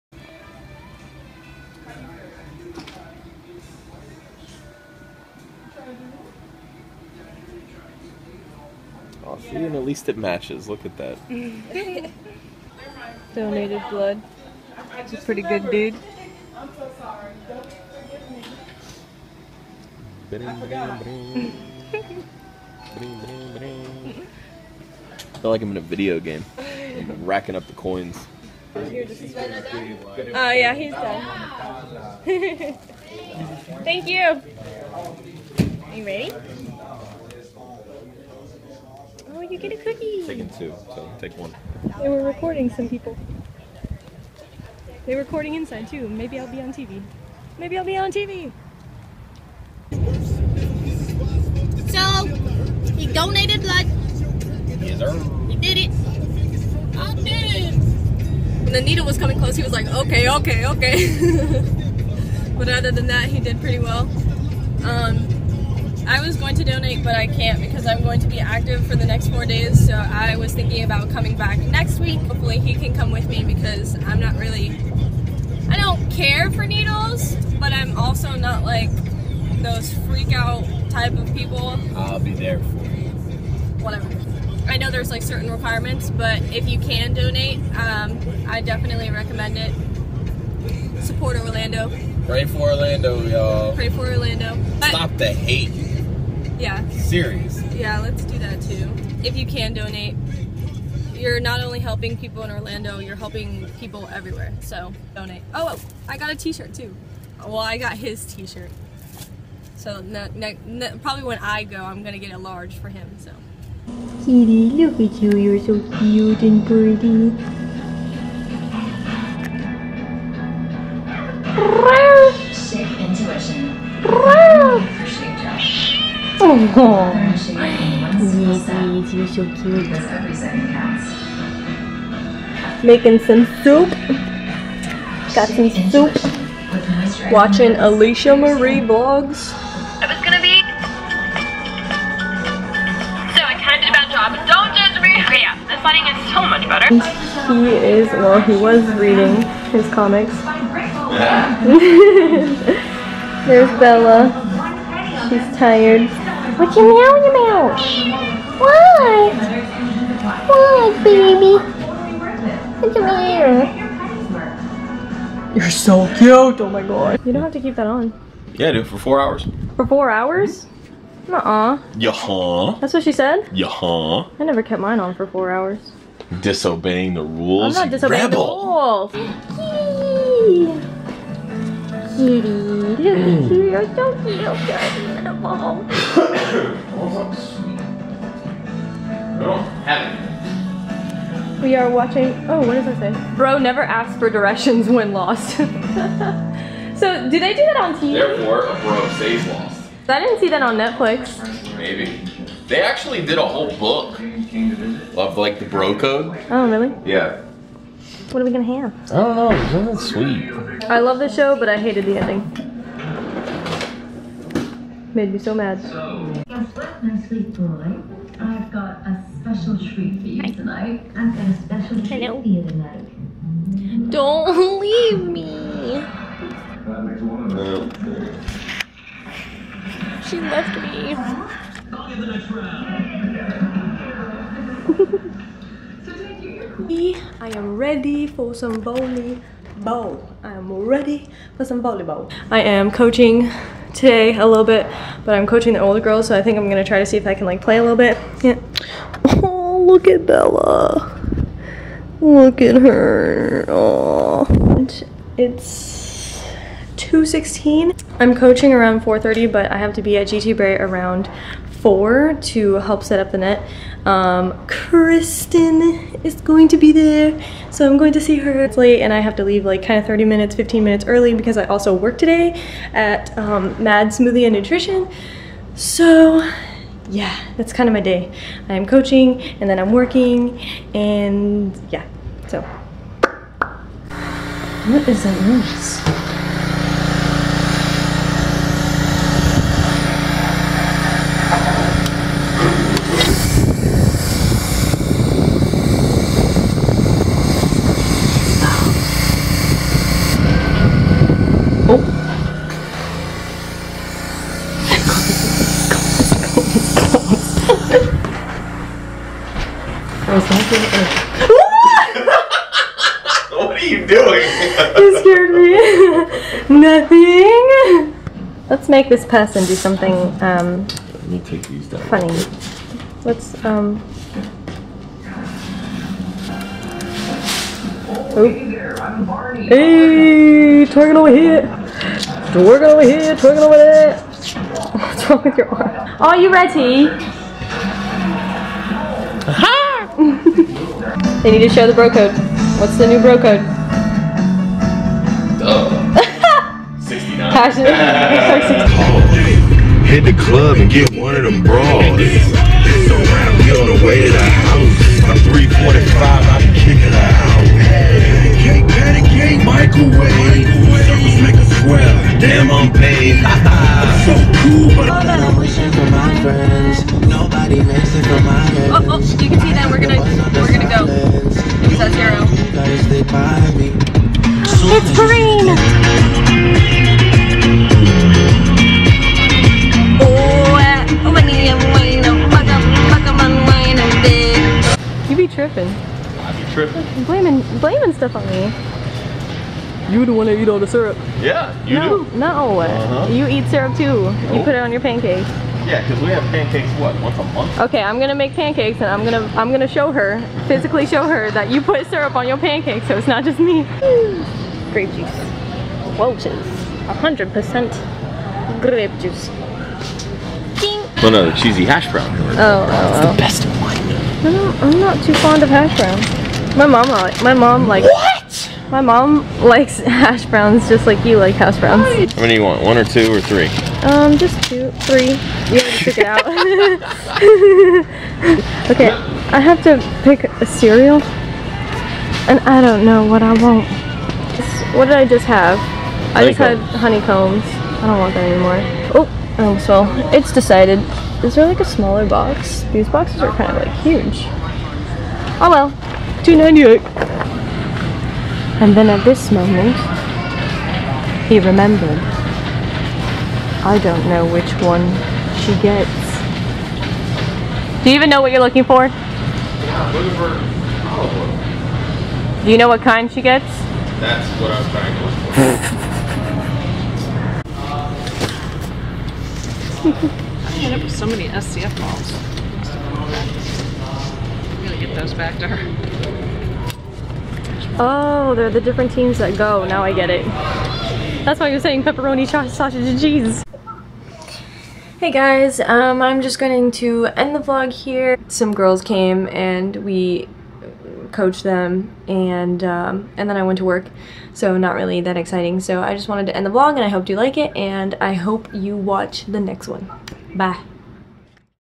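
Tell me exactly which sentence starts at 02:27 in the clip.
He is, well, he was reading his comics.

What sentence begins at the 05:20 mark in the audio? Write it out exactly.
Um, Let me take these down.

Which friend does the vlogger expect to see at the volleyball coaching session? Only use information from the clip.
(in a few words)
Kristen.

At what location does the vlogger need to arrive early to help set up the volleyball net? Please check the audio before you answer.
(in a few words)
GT Bray.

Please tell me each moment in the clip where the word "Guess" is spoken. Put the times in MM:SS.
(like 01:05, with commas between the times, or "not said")
03:35.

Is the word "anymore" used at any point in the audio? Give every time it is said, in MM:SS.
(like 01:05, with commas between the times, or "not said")
07:18.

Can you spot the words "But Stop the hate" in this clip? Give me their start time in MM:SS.
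01:34.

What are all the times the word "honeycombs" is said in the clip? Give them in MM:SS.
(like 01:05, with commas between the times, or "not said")
07:16.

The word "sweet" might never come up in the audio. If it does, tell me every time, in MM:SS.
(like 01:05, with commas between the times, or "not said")
03:29, 03:37.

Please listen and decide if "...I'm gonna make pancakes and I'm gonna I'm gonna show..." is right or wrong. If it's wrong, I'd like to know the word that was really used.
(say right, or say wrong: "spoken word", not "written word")
right.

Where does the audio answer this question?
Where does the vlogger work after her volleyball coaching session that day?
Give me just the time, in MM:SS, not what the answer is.
04:33.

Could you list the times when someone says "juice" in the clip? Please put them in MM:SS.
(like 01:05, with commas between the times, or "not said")
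06:45, 06:49.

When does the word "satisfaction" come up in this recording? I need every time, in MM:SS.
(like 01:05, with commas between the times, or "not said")
not said.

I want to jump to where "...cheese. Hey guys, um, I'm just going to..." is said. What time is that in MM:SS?
08:03.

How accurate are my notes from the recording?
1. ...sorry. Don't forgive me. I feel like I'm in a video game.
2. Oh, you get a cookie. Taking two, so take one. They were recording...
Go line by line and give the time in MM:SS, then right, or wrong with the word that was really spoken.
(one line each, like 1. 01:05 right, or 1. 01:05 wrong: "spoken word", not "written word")
1. 00:16 right
2. 00:39 right.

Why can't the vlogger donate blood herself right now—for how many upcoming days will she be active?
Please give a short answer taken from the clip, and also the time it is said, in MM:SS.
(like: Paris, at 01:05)
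4, at 01:09.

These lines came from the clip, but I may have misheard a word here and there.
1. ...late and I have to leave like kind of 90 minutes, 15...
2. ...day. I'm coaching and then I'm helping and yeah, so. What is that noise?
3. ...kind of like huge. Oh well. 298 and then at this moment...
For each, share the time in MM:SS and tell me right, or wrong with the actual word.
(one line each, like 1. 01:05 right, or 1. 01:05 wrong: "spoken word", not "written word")
1. 04:28 wrong: "30", not "90"
2. 04:38 wrong: "working", not "helping"
3. 07:23 right.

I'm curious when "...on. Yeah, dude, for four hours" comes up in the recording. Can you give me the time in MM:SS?
02:47.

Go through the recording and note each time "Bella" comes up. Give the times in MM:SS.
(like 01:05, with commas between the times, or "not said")
02:33, 04:10.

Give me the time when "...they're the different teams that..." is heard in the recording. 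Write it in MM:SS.
07:58.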